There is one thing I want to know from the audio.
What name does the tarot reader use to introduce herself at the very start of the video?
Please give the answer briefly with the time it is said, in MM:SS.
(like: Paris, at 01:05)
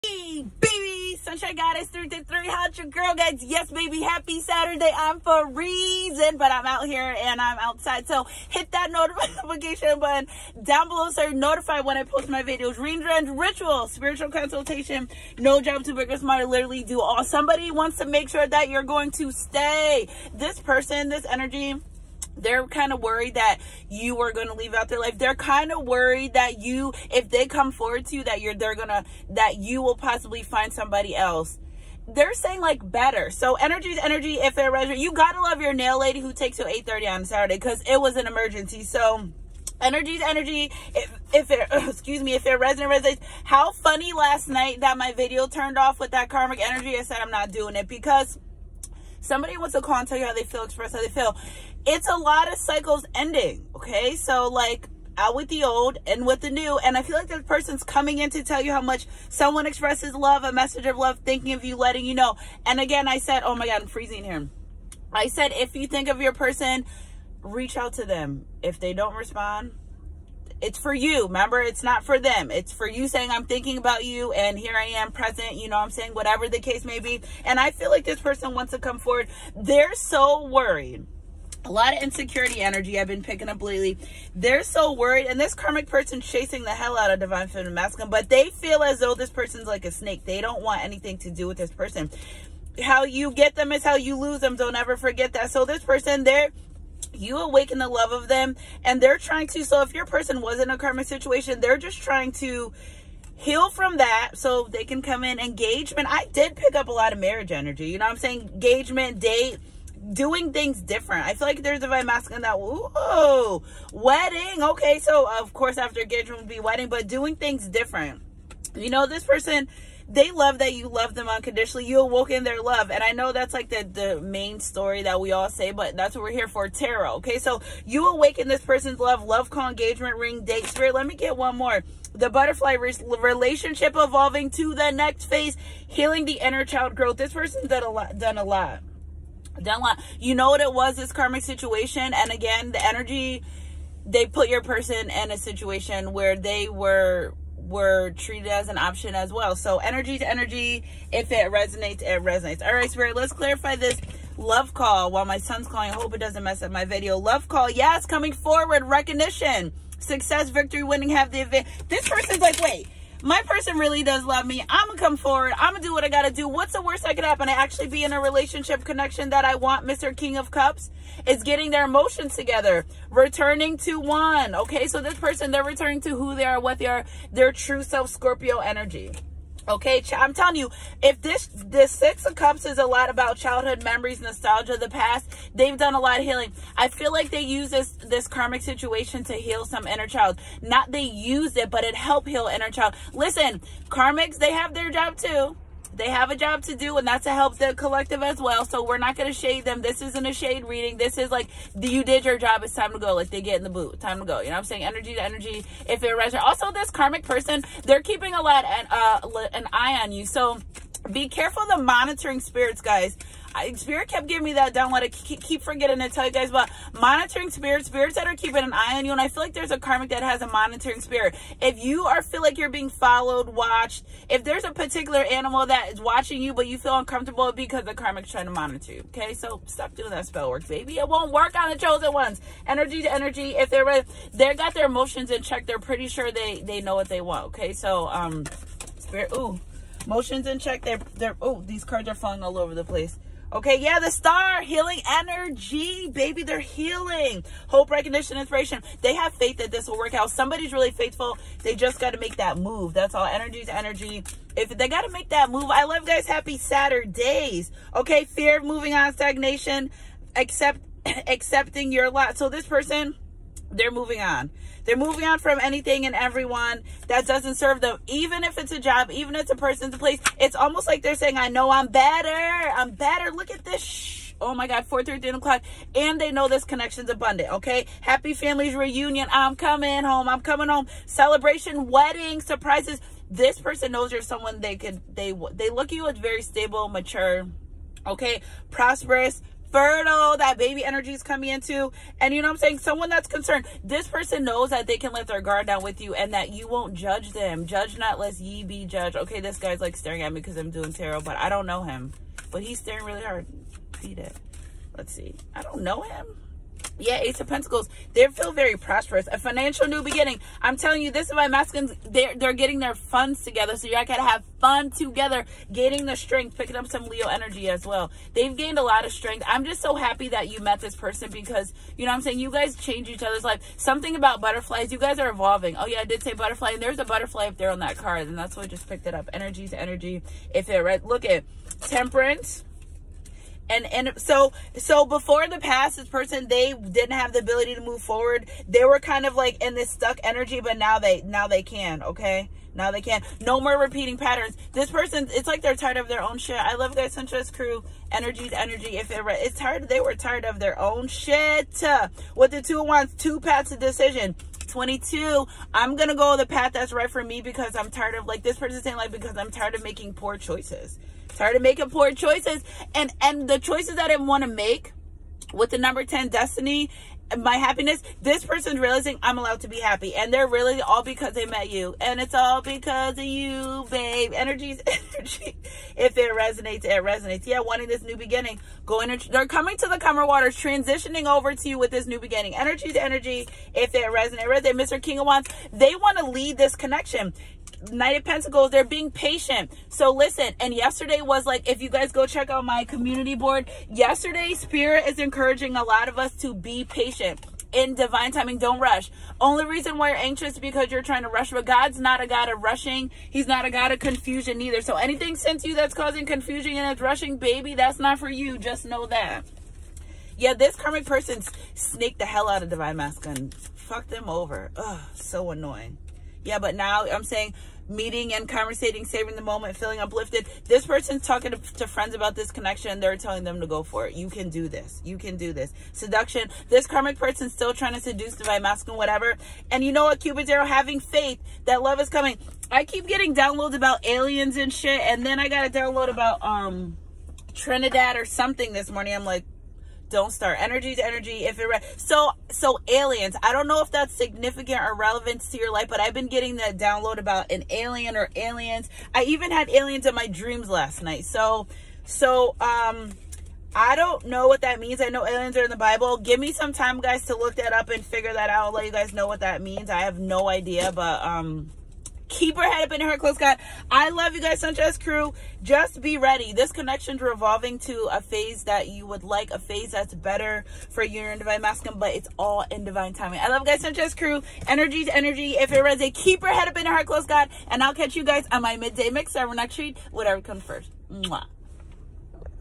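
Sunshine Goddess 333, at 00:01.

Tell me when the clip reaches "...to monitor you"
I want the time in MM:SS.
03:48.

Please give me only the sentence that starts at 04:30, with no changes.
It's almost like they're saying, I know I'm better.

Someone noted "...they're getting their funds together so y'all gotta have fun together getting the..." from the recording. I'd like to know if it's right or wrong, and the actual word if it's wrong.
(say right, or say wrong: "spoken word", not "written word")
right.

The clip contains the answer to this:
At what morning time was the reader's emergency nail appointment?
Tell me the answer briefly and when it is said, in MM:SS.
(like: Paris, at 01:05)
8:30, at 00:36.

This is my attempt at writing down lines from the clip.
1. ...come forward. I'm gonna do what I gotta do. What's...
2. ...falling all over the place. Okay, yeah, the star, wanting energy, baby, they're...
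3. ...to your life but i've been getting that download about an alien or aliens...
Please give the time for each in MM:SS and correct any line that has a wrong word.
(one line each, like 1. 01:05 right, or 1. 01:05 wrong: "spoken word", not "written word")
1. 02:44 right
2. 04:02 wrong: "healing", not "wanting"
3. 07:25 right.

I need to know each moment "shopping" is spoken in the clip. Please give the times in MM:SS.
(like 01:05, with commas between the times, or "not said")
not said.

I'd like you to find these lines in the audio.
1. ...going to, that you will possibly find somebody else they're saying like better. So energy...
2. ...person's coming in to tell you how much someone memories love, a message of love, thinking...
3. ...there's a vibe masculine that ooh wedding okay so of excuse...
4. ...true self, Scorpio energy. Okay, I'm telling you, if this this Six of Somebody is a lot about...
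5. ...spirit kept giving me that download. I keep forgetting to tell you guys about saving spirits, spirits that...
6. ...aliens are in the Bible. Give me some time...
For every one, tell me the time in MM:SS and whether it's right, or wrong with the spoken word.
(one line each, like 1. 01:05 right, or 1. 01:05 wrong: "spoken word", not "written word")
1. 00:28 right
2. 00:57 wrong: "expresses", not "memories"
3. 01:51 wrong: "course", not "excuse"
4. 02:57 wrong: "Cups", not "Somebody"
5. 03:33 wrong: "monitoring", not "saving"
6. 07:35 right.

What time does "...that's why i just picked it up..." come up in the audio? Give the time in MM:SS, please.
05:28.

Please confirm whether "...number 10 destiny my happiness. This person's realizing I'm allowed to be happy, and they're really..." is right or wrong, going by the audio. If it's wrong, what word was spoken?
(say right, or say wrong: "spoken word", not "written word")
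right.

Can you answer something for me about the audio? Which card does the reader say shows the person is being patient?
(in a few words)
Knight of Pentacles.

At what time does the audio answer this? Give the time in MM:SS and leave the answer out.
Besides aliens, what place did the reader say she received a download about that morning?
07:17.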